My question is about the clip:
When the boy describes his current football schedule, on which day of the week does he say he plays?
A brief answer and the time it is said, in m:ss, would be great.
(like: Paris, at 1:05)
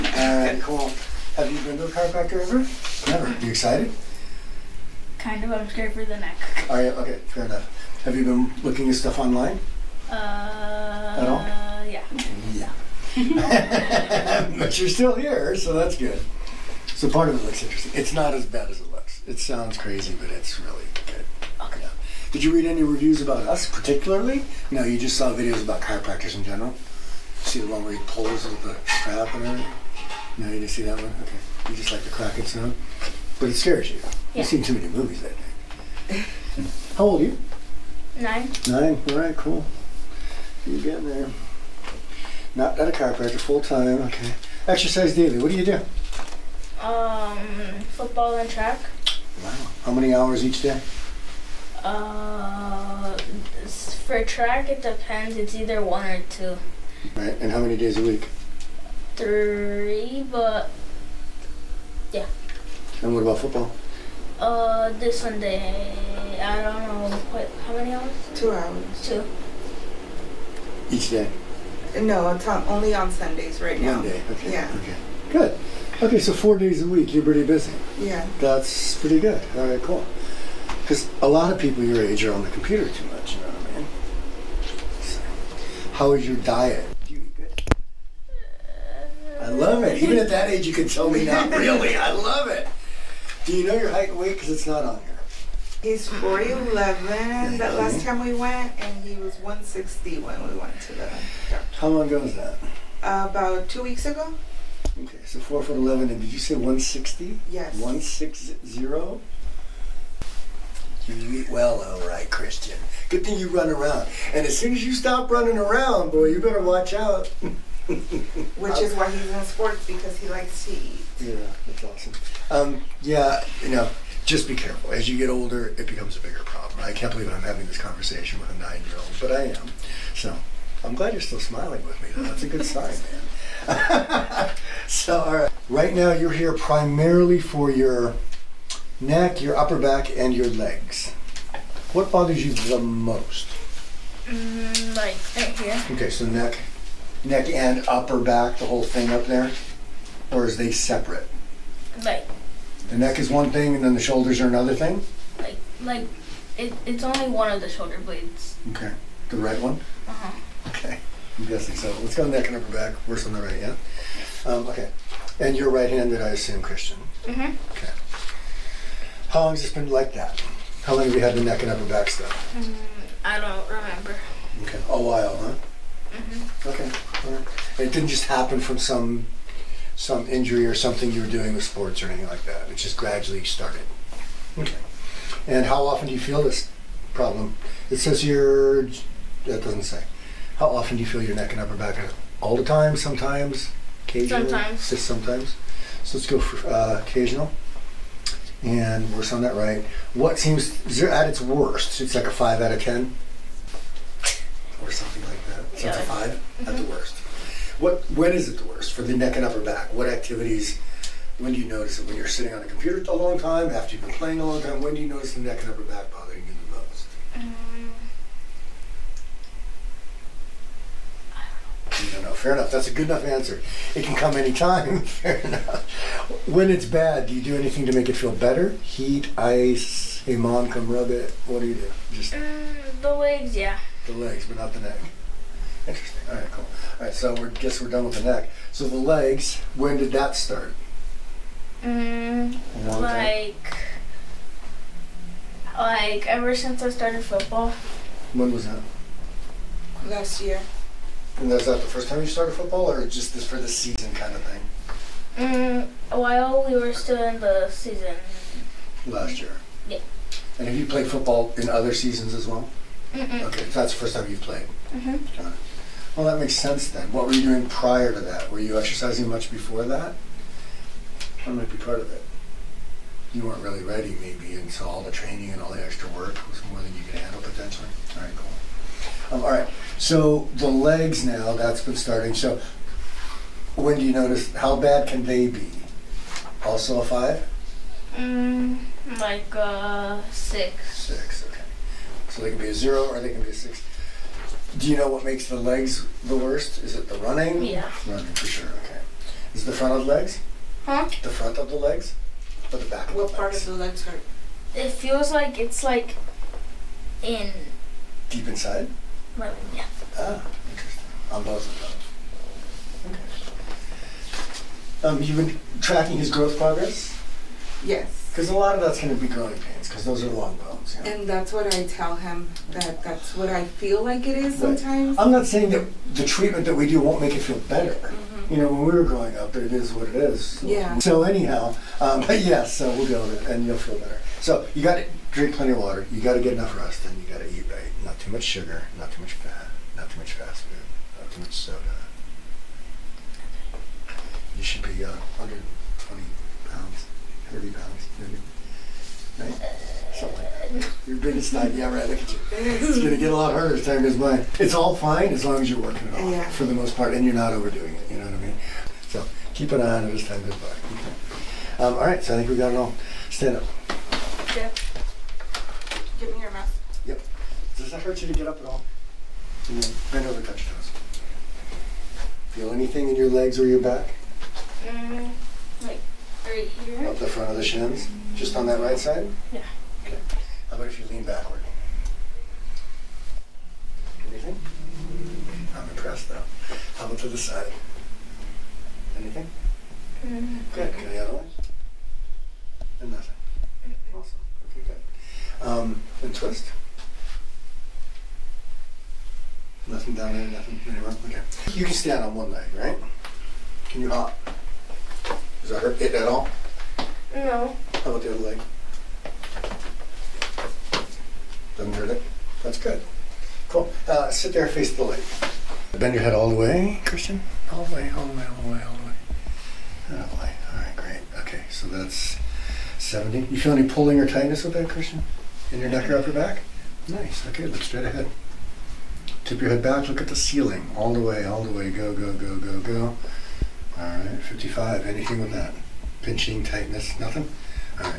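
Sunday, at 1:05.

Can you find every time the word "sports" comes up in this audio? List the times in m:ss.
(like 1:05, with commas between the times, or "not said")
1:59, 3:01.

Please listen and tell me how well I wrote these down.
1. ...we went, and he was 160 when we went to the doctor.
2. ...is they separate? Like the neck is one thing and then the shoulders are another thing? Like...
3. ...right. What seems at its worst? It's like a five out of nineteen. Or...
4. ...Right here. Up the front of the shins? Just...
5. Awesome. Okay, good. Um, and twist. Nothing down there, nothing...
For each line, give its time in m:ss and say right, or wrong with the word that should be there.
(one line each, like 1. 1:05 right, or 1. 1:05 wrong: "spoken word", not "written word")
1. 1:38 right
2. 2:30 right
3. 3:19 wrong: "ten", not "nineteen"
4. 6:16 right
5. 6:34 right.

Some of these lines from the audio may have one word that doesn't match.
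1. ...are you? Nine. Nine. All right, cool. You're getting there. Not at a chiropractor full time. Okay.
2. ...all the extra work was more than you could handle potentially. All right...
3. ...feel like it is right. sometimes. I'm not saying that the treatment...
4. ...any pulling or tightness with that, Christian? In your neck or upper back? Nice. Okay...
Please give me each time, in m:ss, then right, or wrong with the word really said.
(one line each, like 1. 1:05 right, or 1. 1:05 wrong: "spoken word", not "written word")
1. 0:37 right
2. 4:35 right
3. 5:23 right
4. 7:03 right.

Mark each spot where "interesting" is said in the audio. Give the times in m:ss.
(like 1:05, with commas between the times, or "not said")
0:17, 3:55, 5:10.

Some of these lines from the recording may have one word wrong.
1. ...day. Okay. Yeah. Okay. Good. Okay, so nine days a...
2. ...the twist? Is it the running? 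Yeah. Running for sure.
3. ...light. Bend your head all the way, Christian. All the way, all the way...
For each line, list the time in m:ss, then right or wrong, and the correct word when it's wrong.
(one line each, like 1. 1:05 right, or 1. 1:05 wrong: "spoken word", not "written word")
1. 1:14 wrong: "four", not "nine"
2. 4:56 wrong: "worst", not "twist"
3. 6:55 right.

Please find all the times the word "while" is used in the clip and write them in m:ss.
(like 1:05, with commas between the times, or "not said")
2:55, 4:16.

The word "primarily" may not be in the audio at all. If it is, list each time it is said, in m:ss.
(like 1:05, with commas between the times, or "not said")
2:16.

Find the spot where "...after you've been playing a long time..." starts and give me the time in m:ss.
3:33.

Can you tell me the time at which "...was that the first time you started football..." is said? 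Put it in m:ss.
4:11.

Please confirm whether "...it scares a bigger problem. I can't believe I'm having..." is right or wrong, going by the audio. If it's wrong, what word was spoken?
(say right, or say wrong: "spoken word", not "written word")
wrong: "becomes", not "scares".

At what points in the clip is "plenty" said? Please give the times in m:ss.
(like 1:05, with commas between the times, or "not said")
5:35.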